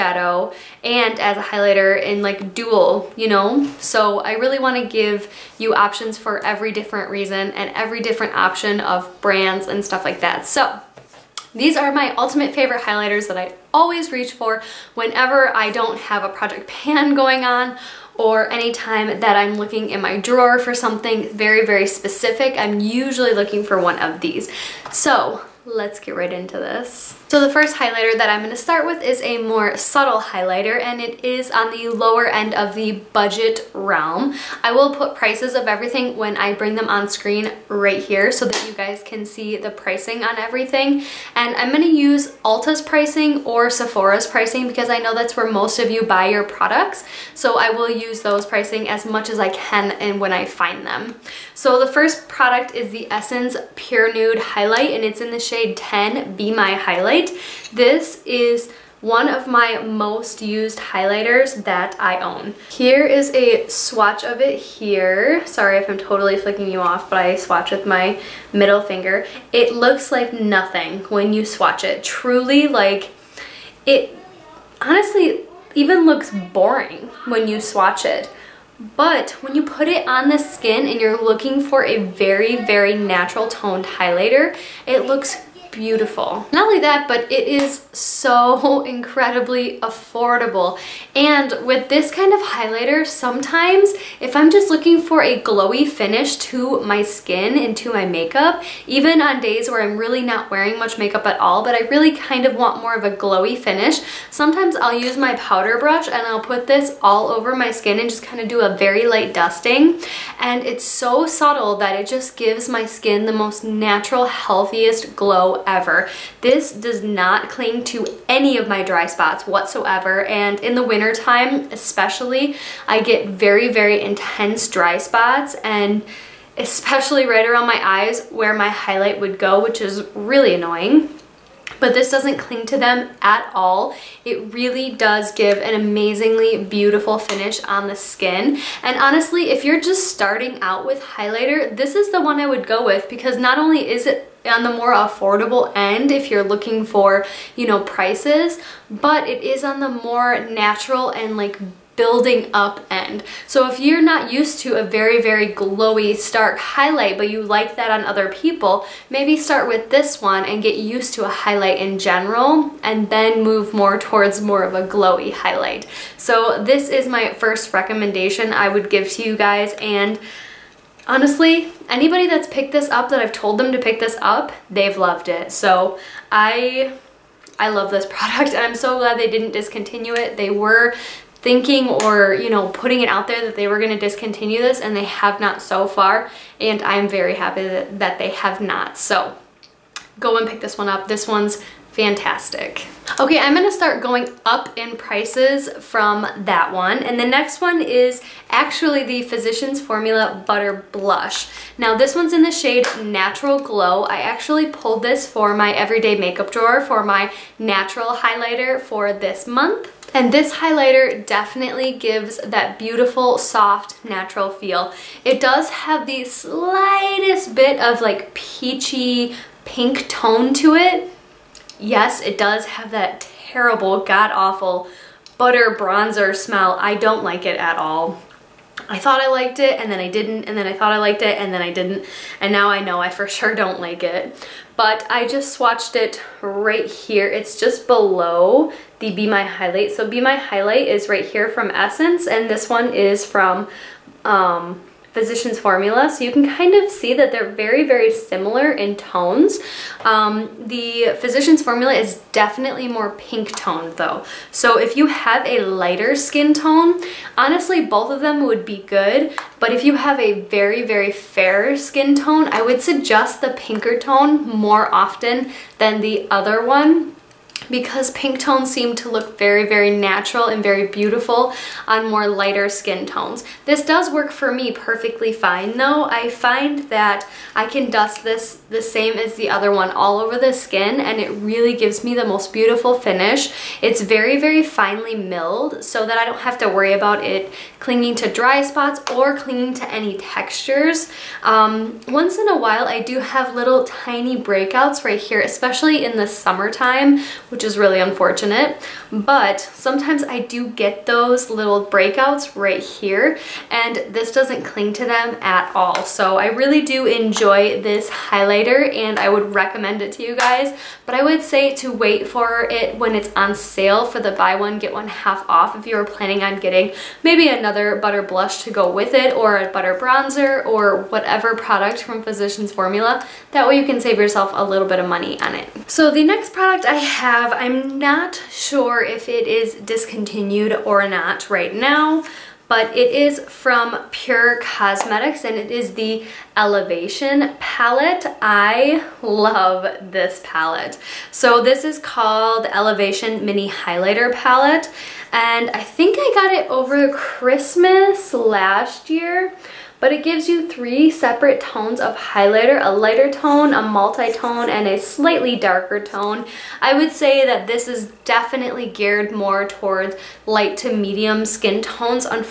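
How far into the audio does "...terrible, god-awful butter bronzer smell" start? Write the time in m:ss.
3:43.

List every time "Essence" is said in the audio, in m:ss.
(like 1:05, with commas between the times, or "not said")
0:53, 4:01.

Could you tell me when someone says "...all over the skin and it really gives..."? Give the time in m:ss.
4:39.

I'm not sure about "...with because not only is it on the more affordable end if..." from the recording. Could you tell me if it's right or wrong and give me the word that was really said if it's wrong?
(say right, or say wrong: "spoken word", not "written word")
right.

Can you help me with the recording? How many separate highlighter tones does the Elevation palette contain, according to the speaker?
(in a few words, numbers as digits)
3.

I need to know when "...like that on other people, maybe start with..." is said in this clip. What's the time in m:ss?
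2:37.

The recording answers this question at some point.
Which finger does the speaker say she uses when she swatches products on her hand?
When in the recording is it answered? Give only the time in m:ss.
1:08.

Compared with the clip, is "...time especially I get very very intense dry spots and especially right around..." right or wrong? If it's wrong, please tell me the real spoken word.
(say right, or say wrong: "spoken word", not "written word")
right.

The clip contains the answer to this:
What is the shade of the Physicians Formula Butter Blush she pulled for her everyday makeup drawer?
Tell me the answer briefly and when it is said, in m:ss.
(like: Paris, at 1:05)
Natural Glow, at 3:23.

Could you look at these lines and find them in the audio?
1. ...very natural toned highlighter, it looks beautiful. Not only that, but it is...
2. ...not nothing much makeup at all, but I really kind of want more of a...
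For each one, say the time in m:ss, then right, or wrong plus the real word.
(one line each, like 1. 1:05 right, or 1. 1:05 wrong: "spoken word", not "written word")
1. 1:22 right
2. 1:40 wrong: "wearing", not "nothing".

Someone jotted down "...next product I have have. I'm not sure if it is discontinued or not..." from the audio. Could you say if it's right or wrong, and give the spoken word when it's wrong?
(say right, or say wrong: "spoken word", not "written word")
right.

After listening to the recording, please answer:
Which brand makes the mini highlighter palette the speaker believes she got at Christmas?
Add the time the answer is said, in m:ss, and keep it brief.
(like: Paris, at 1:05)
Pur Cosmetics, at 5:34.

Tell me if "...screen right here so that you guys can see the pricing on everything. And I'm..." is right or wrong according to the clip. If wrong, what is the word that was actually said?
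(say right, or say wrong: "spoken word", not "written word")
right.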